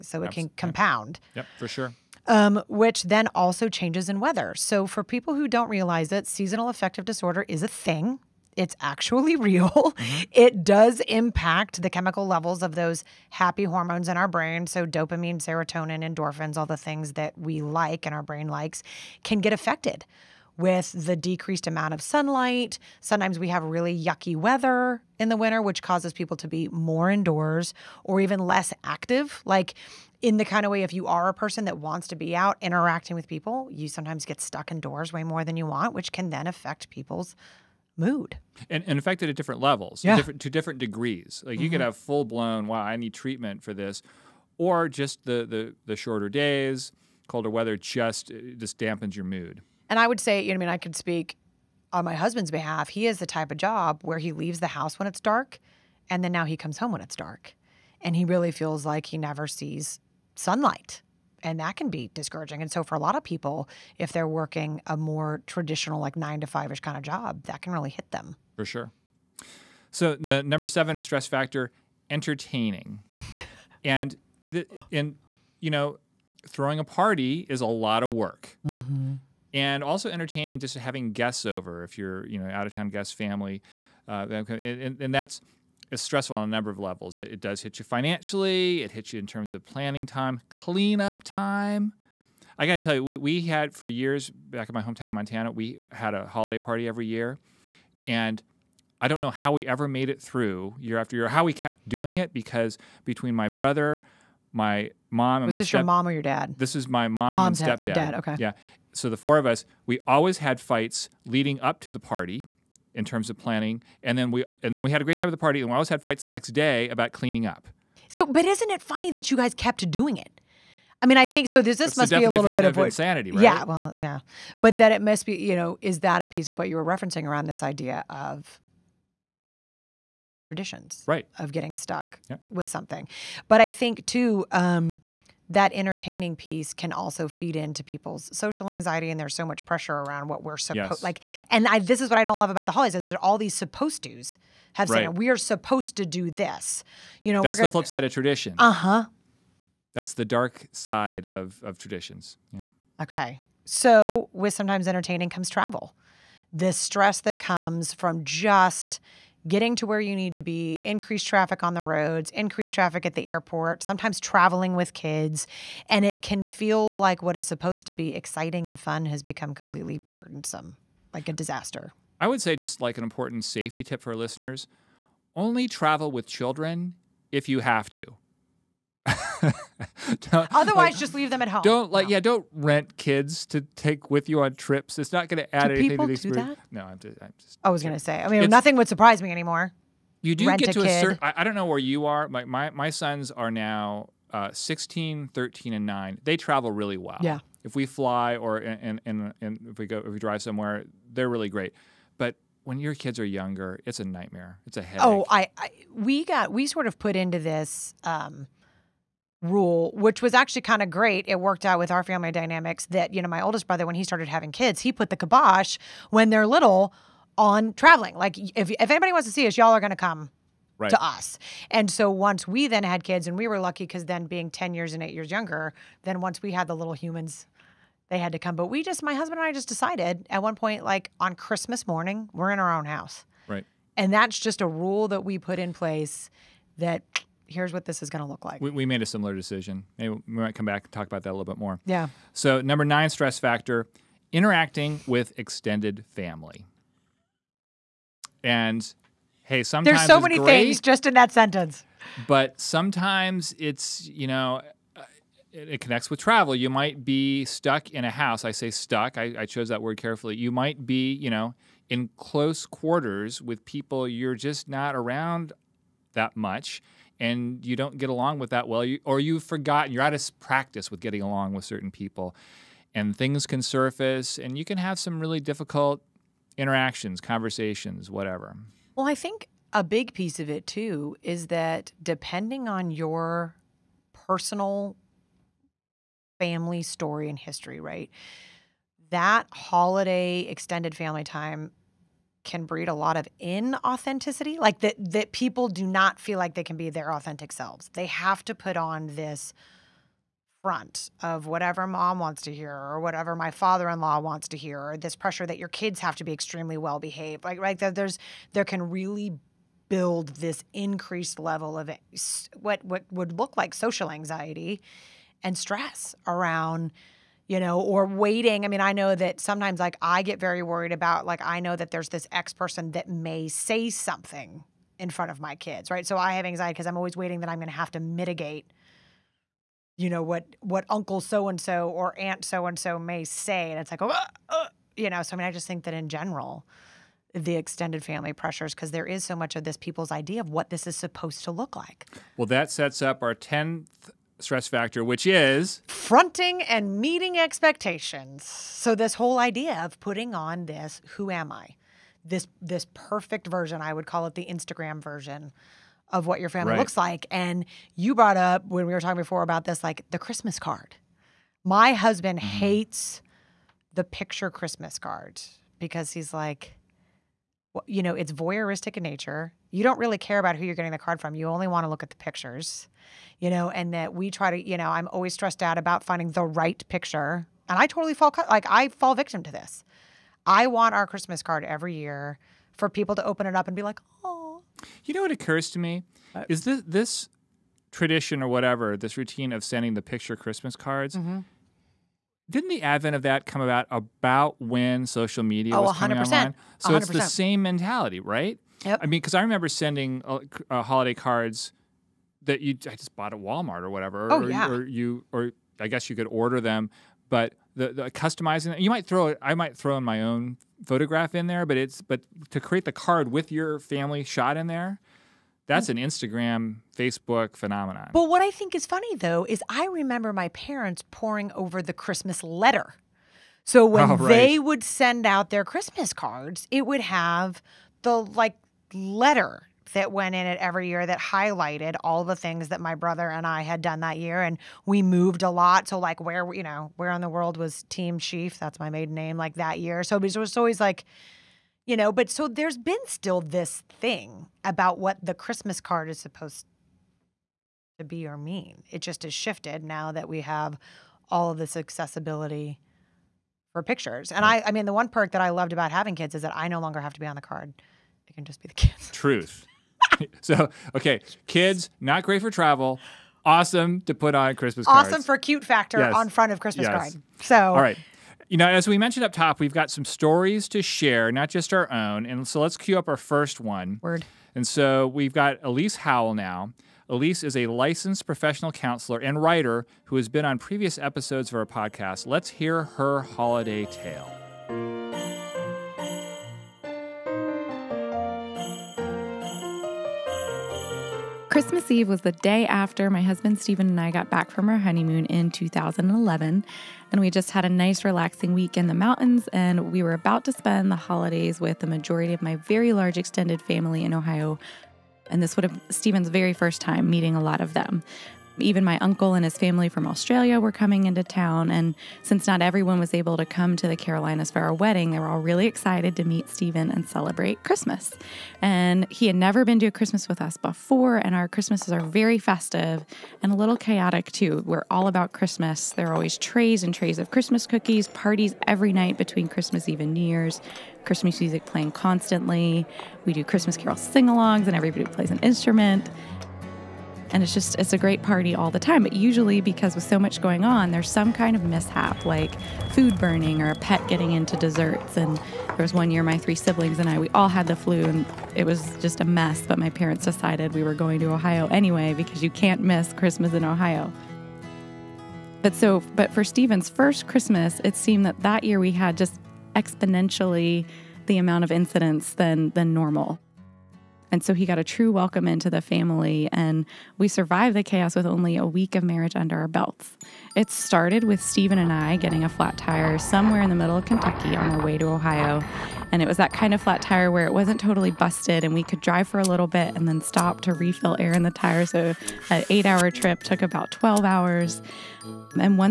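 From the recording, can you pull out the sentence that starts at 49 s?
And I would say, you know, I mean, I could speak on my husband's behalf.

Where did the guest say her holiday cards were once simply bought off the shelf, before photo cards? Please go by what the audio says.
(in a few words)
Walmart.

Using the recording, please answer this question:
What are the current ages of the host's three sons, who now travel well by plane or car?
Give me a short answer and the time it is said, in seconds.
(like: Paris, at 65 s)
16, 13, and 9, at 194 s.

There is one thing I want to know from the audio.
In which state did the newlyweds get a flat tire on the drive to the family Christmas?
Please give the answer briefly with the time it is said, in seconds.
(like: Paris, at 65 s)
Kentucky, at 574 s.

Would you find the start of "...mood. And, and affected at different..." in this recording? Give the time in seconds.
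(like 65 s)
37 s.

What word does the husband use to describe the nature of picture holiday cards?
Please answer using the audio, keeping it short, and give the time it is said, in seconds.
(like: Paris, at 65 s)
voyeuristic, at 368 s.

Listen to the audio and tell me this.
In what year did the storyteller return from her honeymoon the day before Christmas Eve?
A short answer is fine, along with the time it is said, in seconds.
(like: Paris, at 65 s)
2011, at 495 s.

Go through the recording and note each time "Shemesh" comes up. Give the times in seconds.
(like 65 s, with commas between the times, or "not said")
not said.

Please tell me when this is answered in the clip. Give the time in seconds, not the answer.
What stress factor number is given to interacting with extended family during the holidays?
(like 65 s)
242 s.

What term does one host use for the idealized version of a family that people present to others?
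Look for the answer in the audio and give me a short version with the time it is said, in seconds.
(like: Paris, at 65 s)
the Instagram version, at 354 s.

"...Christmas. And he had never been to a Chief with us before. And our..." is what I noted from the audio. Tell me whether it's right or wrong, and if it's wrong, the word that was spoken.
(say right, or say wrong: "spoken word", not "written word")
wrong: "Christmas", not "Chief".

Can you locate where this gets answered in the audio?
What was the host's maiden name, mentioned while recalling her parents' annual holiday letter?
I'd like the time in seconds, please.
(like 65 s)
438 s.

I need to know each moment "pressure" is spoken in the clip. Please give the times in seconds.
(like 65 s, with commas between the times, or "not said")
139 s, 305 s, 338 s.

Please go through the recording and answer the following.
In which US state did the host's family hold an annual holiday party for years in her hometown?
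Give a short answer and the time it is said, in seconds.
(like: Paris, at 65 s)
Montana, at 95 s.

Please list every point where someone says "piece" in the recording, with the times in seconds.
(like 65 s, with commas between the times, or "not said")
126 s, 136 s, 280 s.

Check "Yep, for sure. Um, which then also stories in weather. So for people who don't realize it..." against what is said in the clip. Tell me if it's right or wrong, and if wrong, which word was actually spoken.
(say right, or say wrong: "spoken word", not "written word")
wrong: "changes", not "stories".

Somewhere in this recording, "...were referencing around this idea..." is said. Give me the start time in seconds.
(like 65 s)
126 s.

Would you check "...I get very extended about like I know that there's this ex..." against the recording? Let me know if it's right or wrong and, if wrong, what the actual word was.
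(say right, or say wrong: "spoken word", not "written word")
wrong: "worried", not "extended".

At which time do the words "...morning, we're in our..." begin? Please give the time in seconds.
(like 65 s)
231 s.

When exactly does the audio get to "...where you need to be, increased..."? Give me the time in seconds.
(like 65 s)
159 s.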